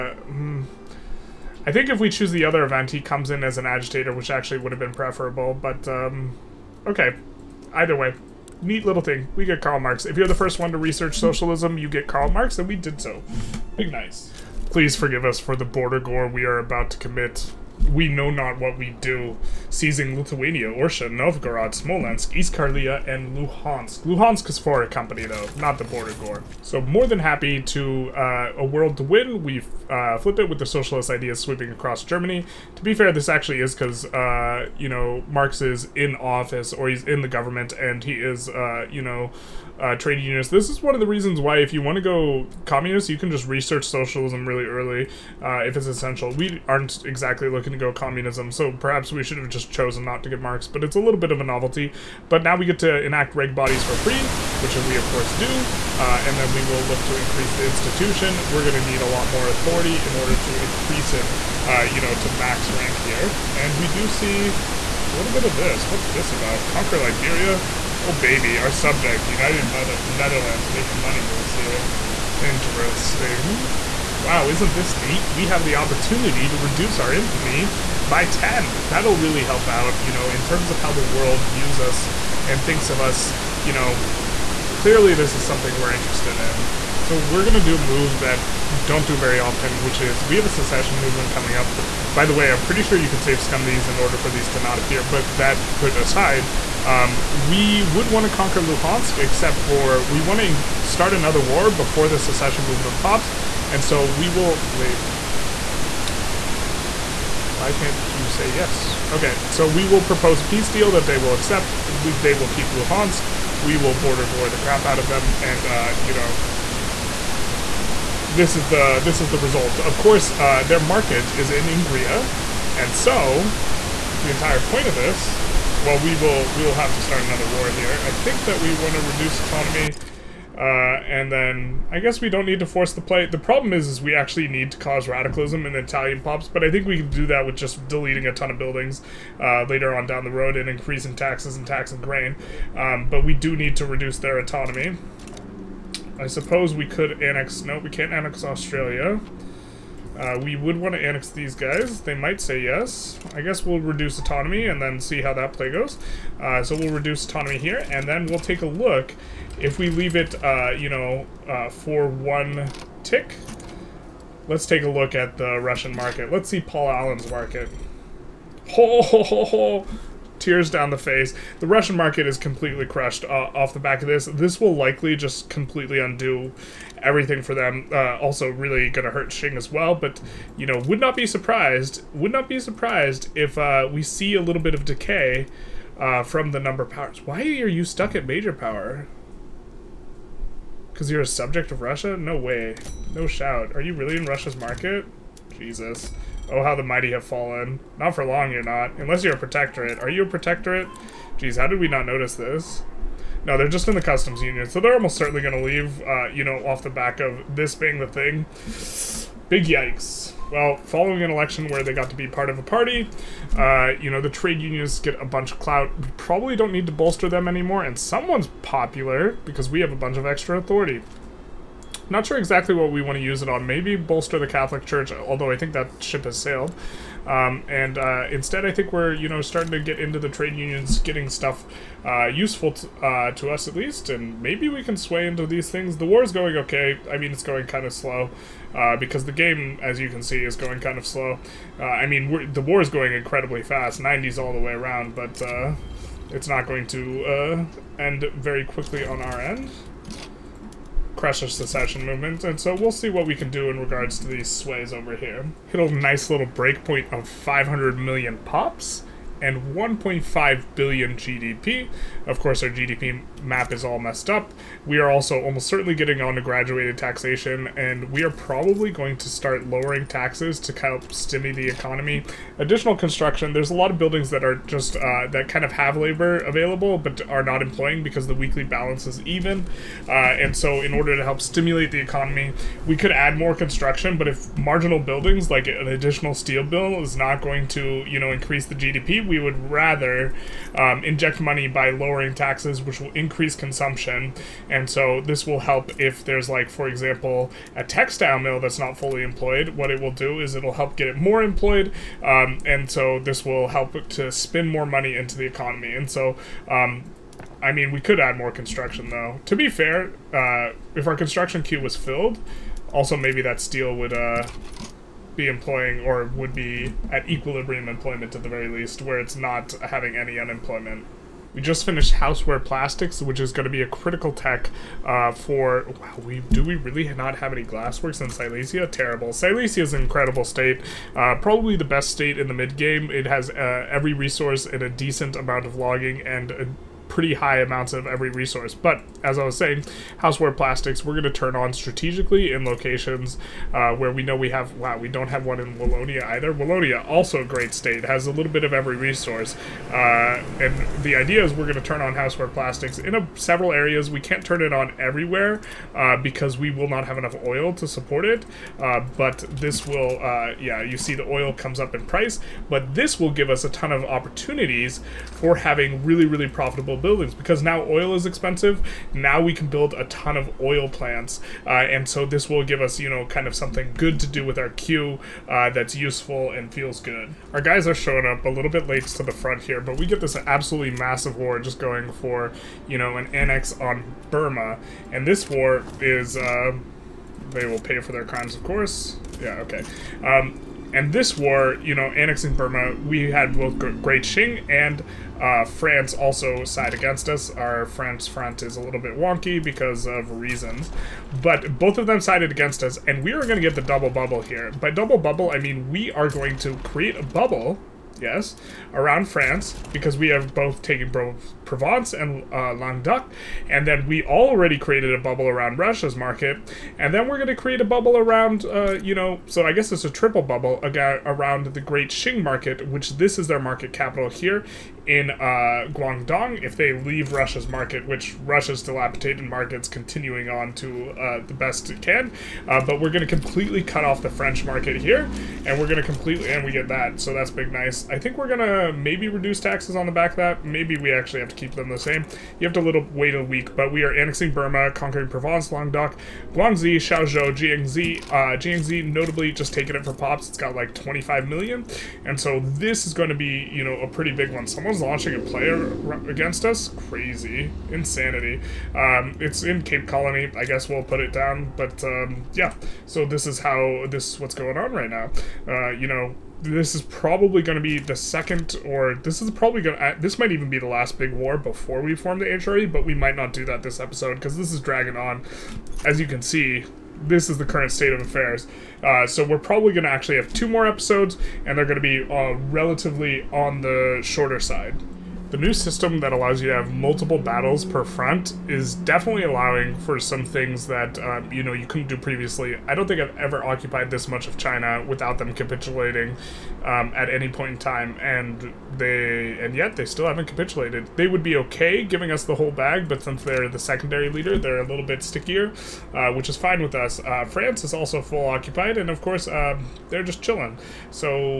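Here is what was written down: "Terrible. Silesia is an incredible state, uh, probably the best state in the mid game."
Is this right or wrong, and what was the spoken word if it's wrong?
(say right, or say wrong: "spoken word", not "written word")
right.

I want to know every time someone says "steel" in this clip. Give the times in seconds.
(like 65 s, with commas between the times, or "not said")
286 s, 313 s.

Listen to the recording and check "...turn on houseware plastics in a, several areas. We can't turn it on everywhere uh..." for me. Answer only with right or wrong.
right.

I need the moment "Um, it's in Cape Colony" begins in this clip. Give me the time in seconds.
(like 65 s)
458 s.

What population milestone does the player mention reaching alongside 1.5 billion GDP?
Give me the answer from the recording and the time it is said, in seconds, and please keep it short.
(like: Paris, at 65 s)
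500 million, at 257 s.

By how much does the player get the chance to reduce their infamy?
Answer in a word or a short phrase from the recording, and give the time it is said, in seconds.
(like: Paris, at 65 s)
10, at 78 s.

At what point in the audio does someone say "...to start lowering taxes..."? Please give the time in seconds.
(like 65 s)
269 s.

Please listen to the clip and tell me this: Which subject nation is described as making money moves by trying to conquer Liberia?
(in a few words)
United Mother Netherlands.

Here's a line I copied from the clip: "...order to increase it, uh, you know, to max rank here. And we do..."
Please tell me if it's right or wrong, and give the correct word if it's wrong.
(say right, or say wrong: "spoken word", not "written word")
right.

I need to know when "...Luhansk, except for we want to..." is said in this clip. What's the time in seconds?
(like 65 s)
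98 s.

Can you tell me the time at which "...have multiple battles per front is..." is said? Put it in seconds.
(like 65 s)
486 s.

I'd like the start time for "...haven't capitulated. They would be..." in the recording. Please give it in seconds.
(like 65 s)
500 s.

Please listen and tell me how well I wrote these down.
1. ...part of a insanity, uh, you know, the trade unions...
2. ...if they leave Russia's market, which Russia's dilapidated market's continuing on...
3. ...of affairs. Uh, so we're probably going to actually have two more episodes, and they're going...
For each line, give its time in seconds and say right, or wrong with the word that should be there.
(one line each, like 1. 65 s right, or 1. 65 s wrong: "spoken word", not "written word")
1. 212 s wrong: "party", not "insanity"
2. 426 s right
3. 478 s right.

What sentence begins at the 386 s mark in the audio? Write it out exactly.
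Uh, they will pay for their crimes, of course.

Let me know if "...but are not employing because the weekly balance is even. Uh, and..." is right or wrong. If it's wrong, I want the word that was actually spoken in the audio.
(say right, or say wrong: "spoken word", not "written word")
right.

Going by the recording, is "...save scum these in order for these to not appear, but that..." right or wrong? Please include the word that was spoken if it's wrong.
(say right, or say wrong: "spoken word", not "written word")
right.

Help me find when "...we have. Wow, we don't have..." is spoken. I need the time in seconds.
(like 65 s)
344 s.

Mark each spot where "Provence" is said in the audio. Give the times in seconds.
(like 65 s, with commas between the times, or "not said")
411 s, 445 s.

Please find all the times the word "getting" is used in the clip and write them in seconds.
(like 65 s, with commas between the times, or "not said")
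230 s, 265 s.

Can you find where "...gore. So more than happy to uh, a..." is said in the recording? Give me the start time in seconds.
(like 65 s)
26 s.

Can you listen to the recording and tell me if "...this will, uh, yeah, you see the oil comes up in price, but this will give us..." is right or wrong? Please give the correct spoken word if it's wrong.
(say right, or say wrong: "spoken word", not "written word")
right.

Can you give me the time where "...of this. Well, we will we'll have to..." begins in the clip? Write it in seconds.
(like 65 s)
124 s.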